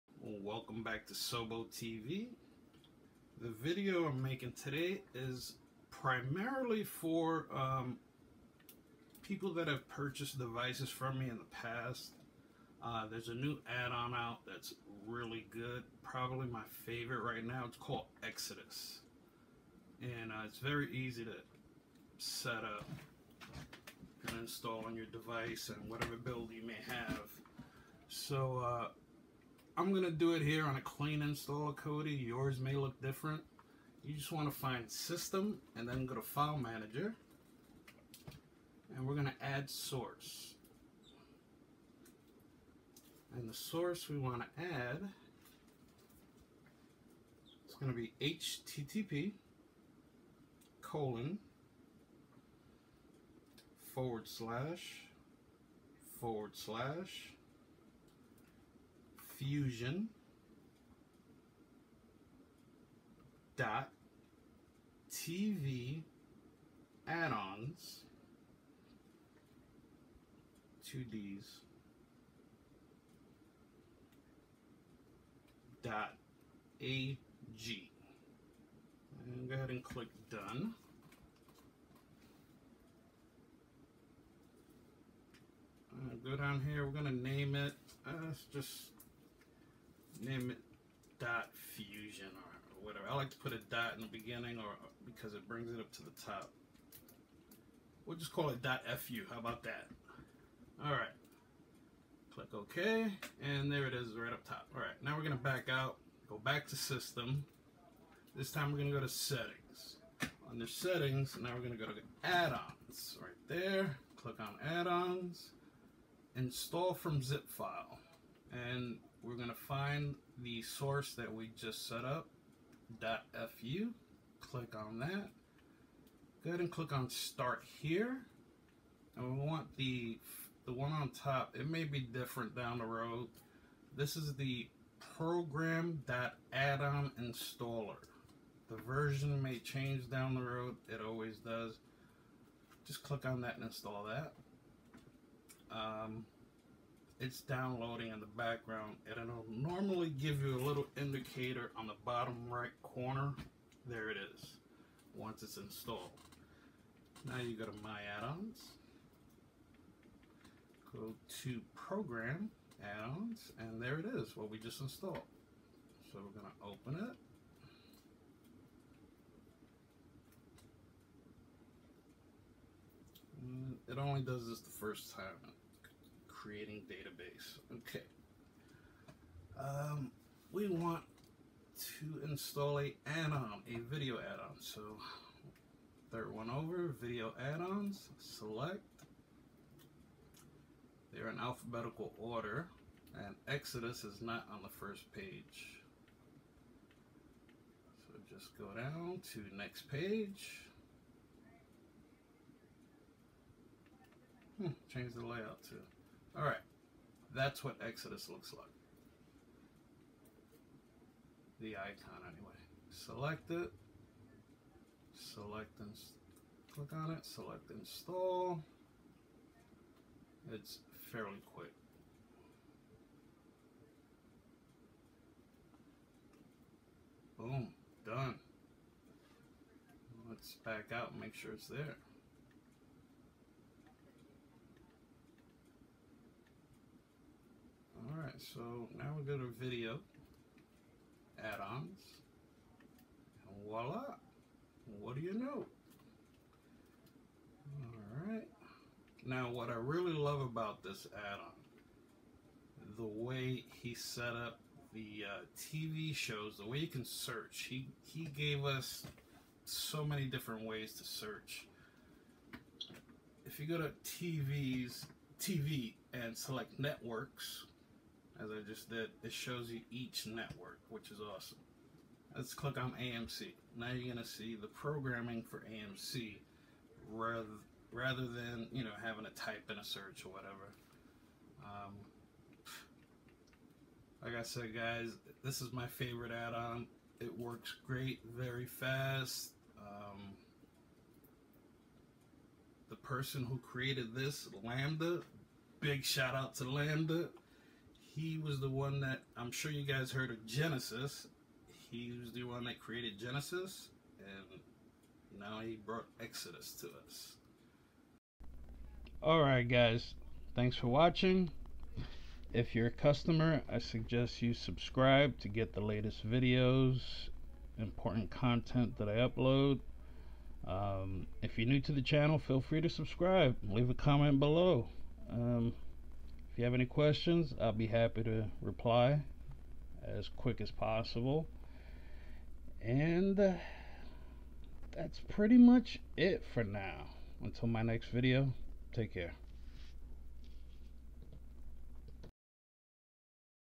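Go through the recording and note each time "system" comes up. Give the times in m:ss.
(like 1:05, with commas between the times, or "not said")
0:34, 1:46.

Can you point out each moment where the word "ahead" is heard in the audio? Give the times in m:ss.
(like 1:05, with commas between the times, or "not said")
1:19, 2:06.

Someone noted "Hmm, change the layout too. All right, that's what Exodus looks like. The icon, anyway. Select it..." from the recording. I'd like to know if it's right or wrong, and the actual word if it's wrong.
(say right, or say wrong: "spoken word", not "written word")
right.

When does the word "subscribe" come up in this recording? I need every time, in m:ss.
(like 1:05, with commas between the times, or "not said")
5:14, 5:22.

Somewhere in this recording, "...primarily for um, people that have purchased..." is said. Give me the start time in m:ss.
0:05.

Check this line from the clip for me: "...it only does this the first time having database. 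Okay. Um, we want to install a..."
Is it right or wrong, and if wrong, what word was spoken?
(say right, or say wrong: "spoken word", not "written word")
wrong: "creating", not "having".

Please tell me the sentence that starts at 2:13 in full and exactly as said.
This is the program add-on installer.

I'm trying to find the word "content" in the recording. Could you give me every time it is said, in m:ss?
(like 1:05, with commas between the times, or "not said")
5:18.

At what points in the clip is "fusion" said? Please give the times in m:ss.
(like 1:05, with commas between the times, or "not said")
0:59, 1:31.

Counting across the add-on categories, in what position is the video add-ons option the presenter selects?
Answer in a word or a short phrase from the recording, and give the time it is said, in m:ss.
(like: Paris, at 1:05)
Third, at 3:06.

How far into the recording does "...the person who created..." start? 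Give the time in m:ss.
4:52.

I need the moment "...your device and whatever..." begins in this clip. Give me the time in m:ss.
0:24.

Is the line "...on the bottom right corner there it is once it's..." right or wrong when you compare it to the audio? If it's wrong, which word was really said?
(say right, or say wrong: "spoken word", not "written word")
right.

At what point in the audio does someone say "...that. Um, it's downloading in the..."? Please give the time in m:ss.
2:24.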